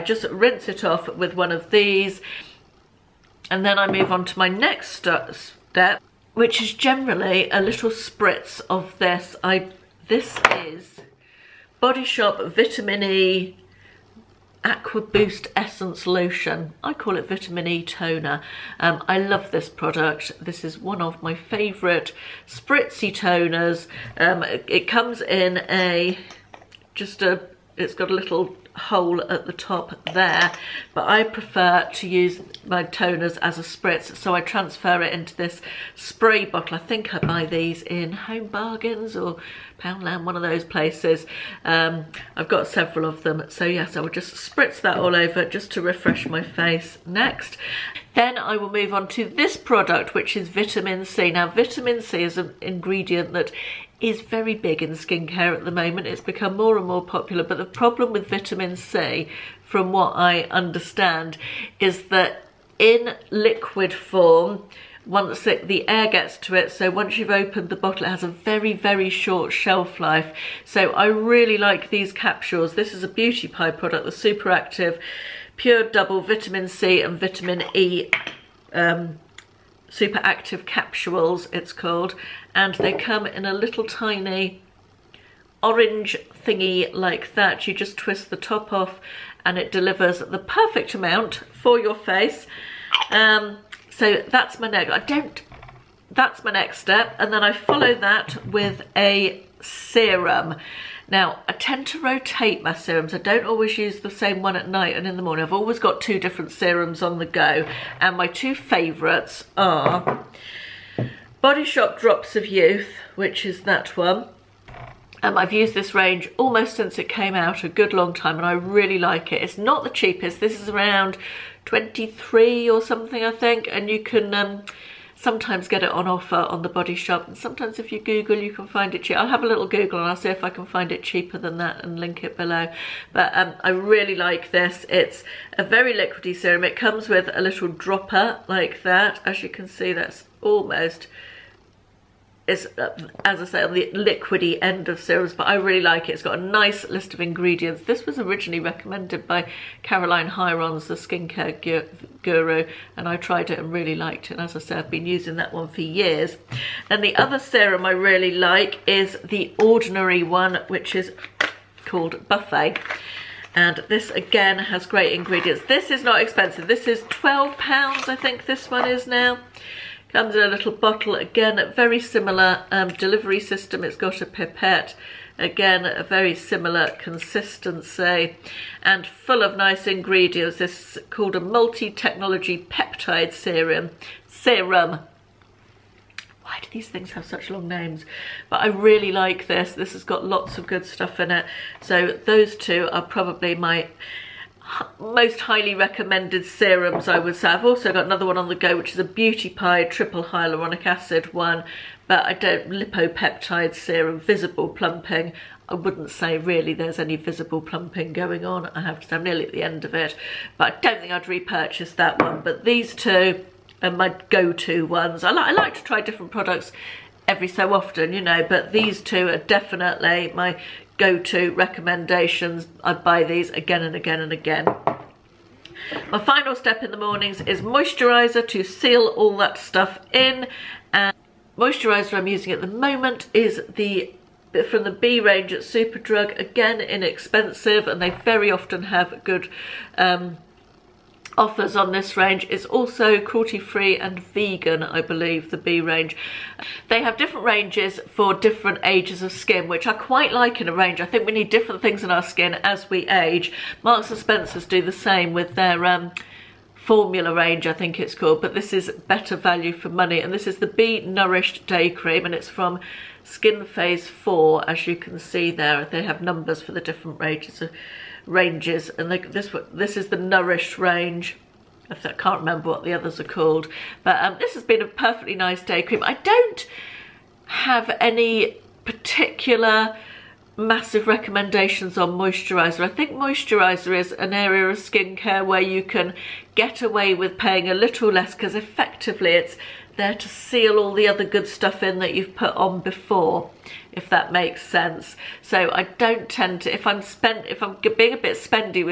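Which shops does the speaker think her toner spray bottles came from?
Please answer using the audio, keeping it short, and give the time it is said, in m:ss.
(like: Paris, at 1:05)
Home Bargains or Poundland, at 0:38.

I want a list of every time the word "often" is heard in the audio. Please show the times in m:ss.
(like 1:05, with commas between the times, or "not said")
3:37, 3:58.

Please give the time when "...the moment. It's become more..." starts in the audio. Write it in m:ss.
0:55.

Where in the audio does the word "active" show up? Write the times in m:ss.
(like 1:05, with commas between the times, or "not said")
1:14, 1:20.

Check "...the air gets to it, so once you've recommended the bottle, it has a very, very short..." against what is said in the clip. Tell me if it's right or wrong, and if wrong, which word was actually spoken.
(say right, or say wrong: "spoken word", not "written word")
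wrong: "opened", not "recommended".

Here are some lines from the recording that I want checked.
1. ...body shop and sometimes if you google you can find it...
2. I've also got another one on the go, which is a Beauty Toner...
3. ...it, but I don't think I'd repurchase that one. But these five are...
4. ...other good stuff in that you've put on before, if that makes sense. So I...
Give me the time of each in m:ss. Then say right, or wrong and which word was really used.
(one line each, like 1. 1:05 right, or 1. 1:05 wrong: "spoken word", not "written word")
1. 2:06 right
2. 3:17 wrong: "Pie", not "Toner"
3. 3:29 wrong: "two", not "five"
4. 4:51 right.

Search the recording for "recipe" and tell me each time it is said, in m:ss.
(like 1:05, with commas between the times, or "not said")
not said.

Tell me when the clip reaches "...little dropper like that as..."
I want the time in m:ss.
2:17.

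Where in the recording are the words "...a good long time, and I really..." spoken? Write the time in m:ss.
1:57.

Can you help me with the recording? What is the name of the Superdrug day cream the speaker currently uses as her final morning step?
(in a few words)
B Nourished Day Cream.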